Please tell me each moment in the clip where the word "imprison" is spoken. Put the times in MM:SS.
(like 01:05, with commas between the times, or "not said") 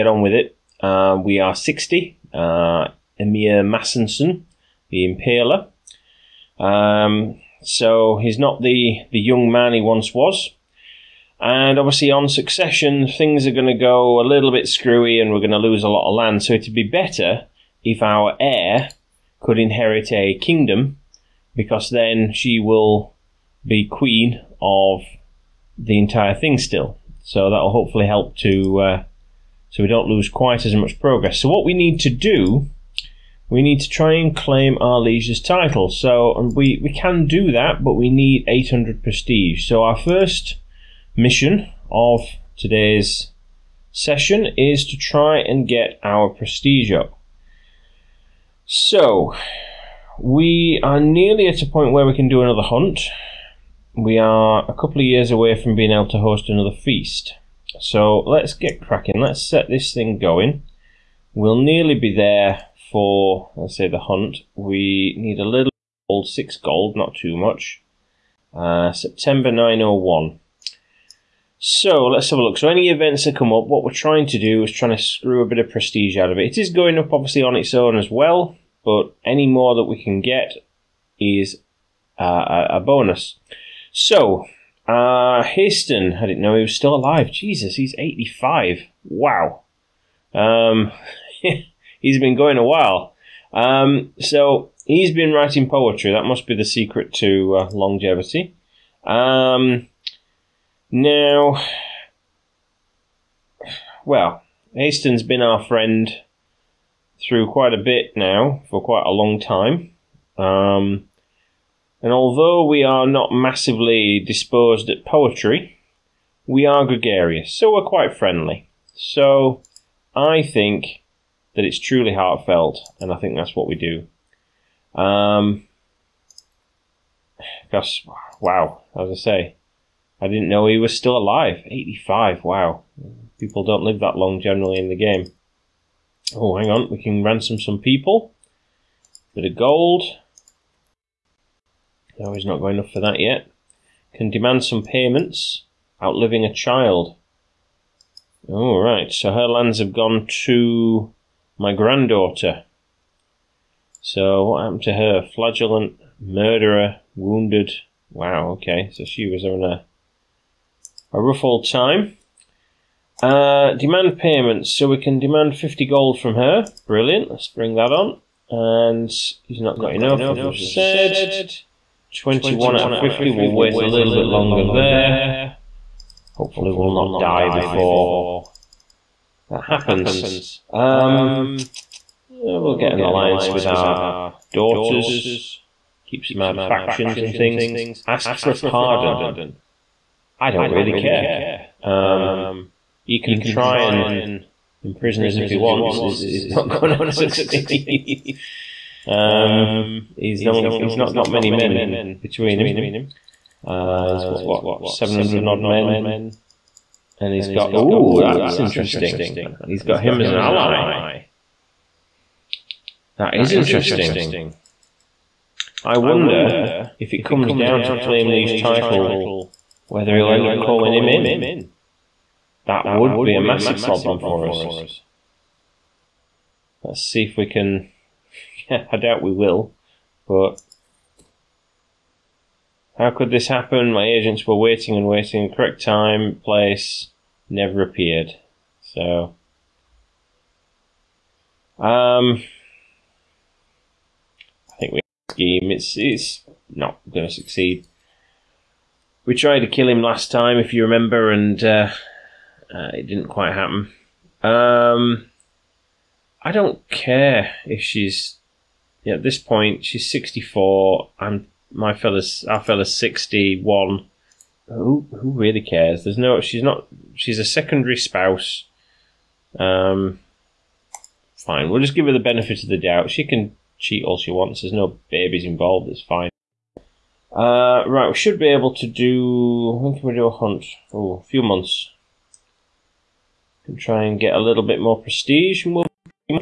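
03:14.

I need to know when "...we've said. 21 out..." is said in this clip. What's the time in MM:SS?
02:50.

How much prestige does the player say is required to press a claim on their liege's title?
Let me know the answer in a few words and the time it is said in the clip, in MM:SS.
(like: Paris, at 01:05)
800, at 00:38.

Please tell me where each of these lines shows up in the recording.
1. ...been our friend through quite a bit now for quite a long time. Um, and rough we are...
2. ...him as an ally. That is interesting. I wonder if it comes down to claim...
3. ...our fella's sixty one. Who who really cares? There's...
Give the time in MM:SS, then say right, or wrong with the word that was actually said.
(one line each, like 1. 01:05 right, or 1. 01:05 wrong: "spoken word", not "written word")
1. 01:45 wrong: "although", not "rough"
2. 03:30 right
3. 04:22 right.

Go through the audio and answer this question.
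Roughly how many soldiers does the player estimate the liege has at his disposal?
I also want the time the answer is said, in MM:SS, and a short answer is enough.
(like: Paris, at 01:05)
700, at 03:24.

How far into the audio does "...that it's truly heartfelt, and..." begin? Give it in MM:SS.
02:01.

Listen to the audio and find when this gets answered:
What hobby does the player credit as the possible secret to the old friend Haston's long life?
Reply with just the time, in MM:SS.
01:35.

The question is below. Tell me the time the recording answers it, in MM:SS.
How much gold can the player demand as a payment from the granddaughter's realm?
02:45.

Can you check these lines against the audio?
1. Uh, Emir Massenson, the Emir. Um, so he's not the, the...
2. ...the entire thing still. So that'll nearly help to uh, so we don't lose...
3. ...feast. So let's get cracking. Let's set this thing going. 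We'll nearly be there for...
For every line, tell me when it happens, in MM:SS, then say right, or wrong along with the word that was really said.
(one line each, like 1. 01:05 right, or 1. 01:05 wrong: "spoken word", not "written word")
1. 00:02 wrong: "Impaler", not "Emir"
2. 00:25 wrong: "hopefully", not "nearly"
3. 00:56 right.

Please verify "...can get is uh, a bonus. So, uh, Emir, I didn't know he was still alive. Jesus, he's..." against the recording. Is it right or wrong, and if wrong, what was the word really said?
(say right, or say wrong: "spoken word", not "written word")
wrong: "Haston", not "Emir".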